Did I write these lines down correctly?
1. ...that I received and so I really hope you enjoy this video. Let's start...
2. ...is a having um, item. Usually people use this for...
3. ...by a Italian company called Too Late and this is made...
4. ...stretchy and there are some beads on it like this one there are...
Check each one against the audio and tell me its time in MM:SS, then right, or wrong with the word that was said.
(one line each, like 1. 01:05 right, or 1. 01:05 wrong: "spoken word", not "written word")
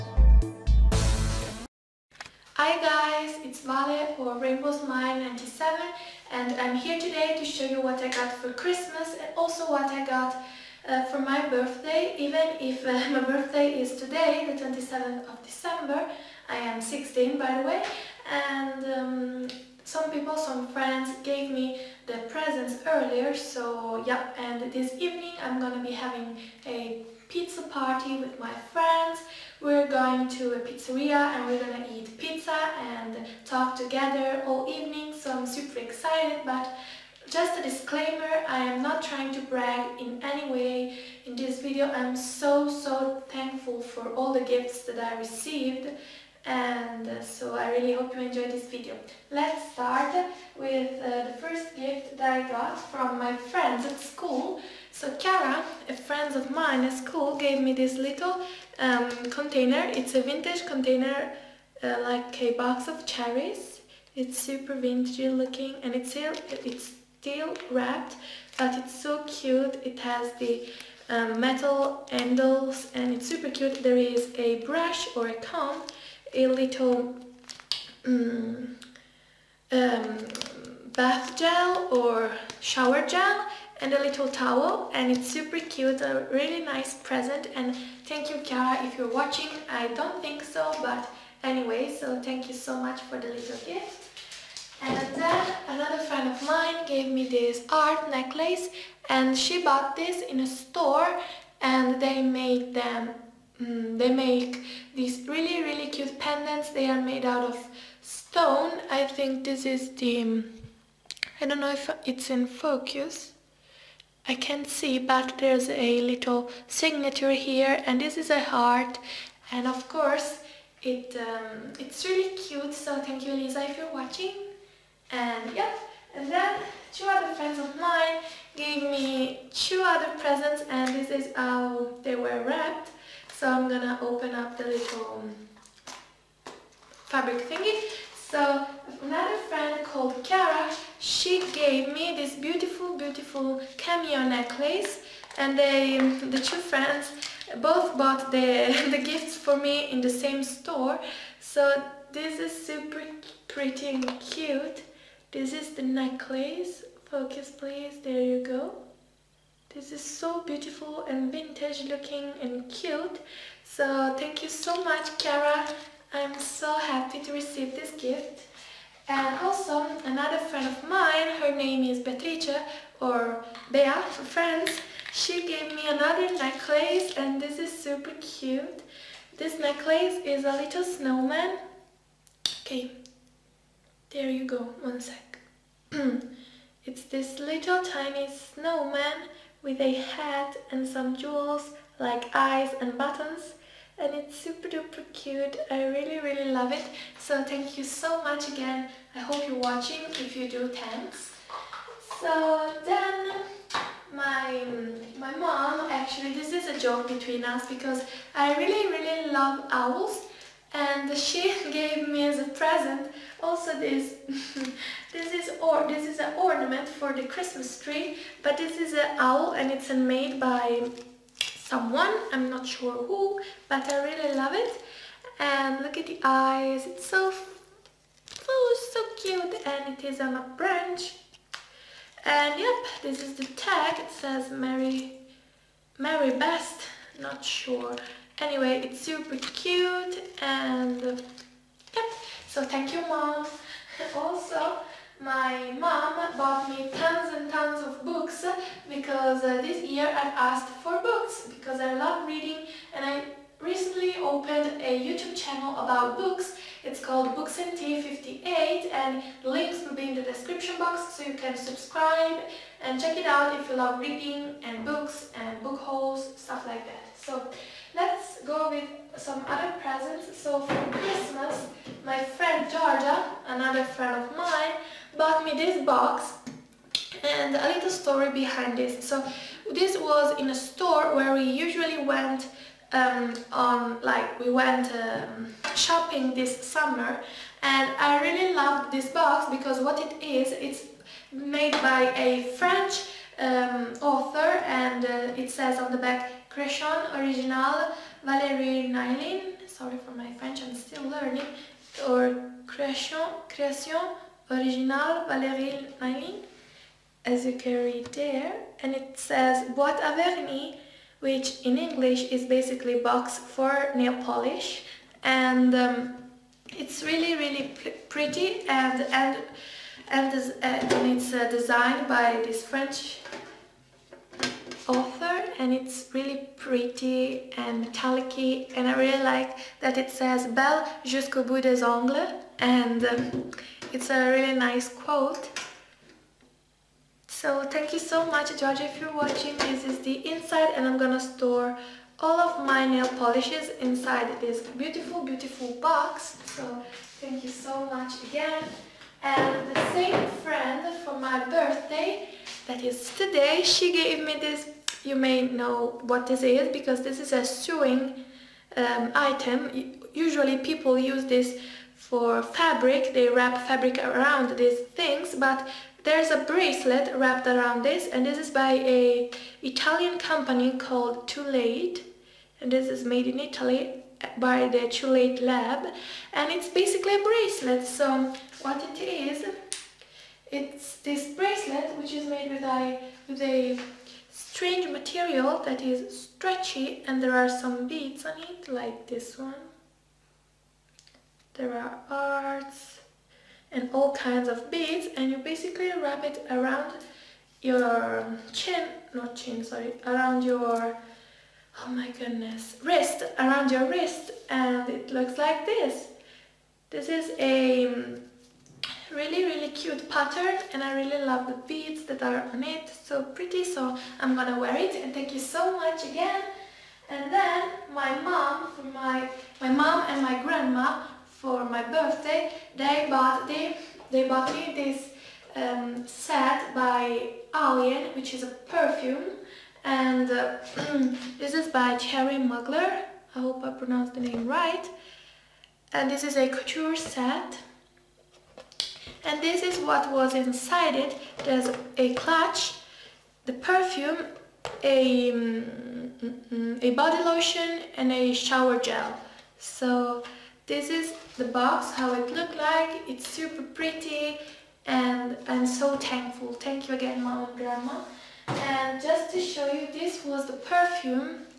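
1. 00:44 right
2. 05:57 wrong: "sewing", not "having"
3. 06:08 right
4. 06:26 right.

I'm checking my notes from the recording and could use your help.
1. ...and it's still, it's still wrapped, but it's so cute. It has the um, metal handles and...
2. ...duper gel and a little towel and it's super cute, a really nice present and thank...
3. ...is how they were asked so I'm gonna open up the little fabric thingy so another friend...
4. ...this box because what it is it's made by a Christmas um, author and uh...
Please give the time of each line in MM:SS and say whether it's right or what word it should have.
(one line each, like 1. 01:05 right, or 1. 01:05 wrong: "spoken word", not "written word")
1. 01:05 right
2. 01:22 wrong: "shower", not "duper"
3. 02:11 wrong: "wrapped", not "asked"
4. 04:48 wrong: "French", not "Christmas".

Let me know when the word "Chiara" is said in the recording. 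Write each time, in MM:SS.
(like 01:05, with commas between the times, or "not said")
00:55, 01:28.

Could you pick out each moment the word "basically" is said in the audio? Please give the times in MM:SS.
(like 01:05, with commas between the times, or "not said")
05:12, 06:16, 06:35.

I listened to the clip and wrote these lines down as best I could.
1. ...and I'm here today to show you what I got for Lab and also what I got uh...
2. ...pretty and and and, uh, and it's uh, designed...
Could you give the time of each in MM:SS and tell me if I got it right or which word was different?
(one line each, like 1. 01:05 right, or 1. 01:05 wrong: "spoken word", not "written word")
1. 00:06 wrong: "Christmas", not "Lab"
2. 05:18 right.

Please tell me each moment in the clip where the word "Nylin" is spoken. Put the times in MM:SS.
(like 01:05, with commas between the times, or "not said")
04:58, 05:06.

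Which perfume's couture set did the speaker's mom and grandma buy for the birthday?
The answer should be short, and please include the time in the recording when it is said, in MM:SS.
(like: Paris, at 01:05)
Alien, at 07:07.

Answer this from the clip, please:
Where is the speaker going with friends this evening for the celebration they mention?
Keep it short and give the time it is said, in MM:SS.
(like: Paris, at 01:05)
A pizzeria, at 00:30.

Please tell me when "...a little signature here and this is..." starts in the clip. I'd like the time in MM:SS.
01:55.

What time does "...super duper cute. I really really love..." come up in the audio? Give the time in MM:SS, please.
03:14.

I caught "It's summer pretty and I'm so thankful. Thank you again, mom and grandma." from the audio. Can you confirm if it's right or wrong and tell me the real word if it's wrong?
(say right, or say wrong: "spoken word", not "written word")
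wrong: "super", not "summer".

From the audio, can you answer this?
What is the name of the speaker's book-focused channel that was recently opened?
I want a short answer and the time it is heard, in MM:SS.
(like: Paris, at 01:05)
Books and Tea 58, at 04:17.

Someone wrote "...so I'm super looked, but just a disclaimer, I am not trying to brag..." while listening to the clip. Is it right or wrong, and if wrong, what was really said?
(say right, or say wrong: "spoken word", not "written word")
wrong: "excited", not "looked".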